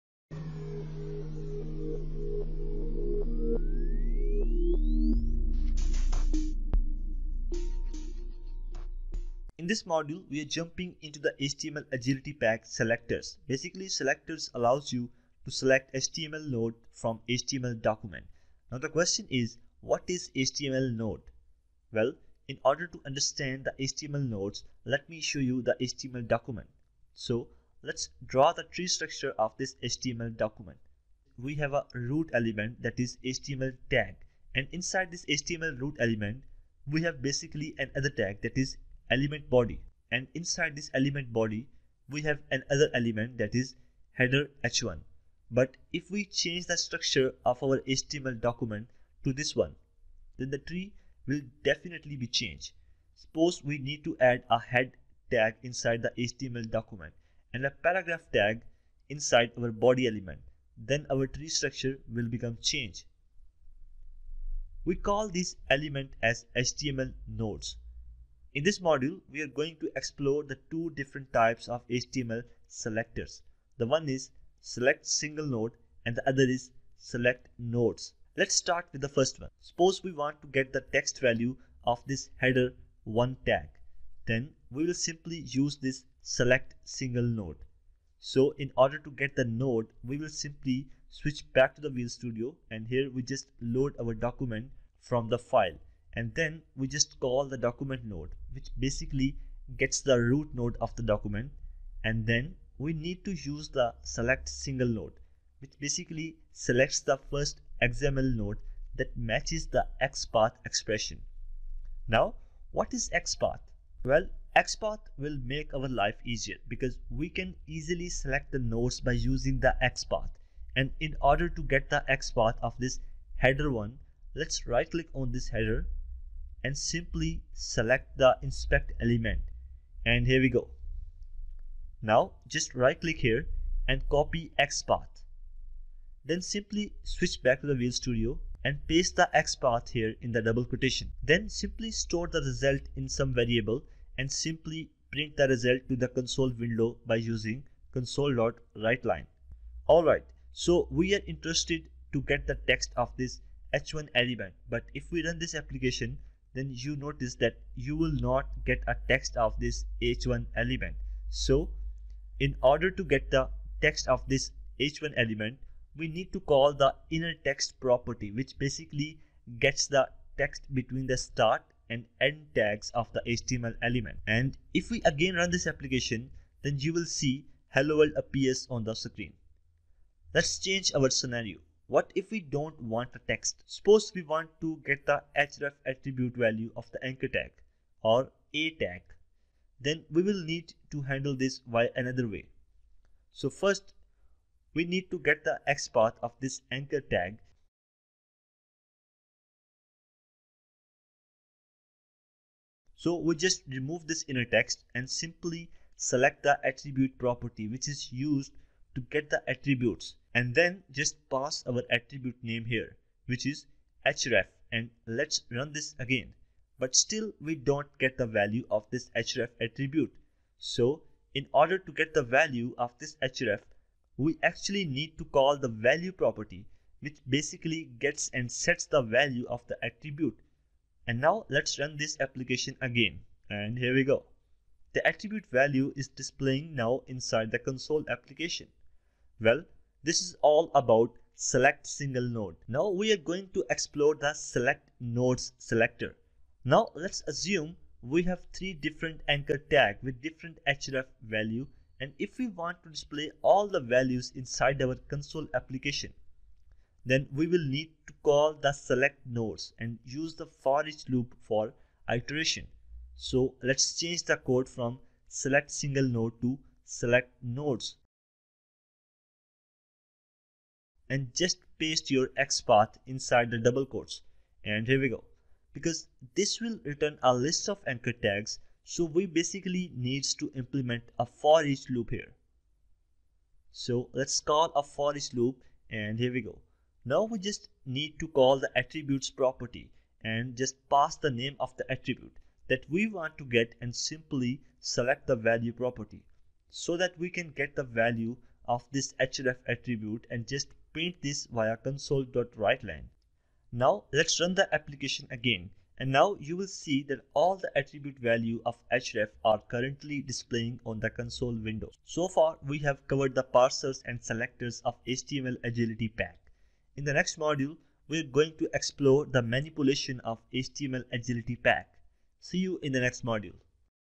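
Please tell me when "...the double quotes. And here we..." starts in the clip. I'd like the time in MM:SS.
04:33.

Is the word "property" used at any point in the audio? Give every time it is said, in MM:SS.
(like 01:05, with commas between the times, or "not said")
02:47, 03:27, 03:46, 04:49, 04:55.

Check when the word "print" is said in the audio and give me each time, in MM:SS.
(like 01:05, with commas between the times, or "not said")
02:25, 05:00.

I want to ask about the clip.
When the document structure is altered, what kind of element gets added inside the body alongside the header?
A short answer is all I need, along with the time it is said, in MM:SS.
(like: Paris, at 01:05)
paragraph tag, at 00:57.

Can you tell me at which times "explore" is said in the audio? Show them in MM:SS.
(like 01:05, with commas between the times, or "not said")
01:09, 04:03, 05:18.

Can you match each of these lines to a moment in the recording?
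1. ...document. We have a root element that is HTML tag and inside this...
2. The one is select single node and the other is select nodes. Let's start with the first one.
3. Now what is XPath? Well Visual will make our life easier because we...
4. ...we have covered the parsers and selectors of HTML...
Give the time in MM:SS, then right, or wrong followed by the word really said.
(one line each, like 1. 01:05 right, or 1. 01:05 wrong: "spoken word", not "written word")
1. 00:30 right
2. 01:13 right
3. 01:52 wrong: "XPath", not "Visual"
4. 05:12 right.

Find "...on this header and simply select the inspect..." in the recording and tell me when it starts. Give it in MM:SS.
02:05.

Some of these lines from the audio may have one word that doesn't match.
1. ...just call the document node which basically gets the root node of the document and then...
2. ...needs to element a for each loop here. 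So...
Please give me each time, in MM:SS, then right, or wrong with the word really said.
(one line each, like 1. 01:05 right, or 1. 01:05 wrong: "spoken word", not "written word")
1. 01:36 right
2. 04:39 wrong: "implement", not "element".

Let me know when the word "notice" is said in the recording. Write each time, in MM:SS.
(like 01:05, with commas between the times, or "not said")
02:36.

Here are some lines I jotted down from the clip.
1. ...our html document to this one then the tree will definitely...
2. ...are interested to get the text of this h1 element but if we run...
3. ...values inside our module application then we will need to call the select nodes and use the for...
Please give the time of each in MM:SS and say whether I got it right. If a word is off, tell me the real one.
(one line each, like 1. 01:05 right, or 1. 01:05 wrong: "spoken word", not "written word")
1. 00:47 right
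2. 02:31 right
3. 04:13 wrong: "console", not "module".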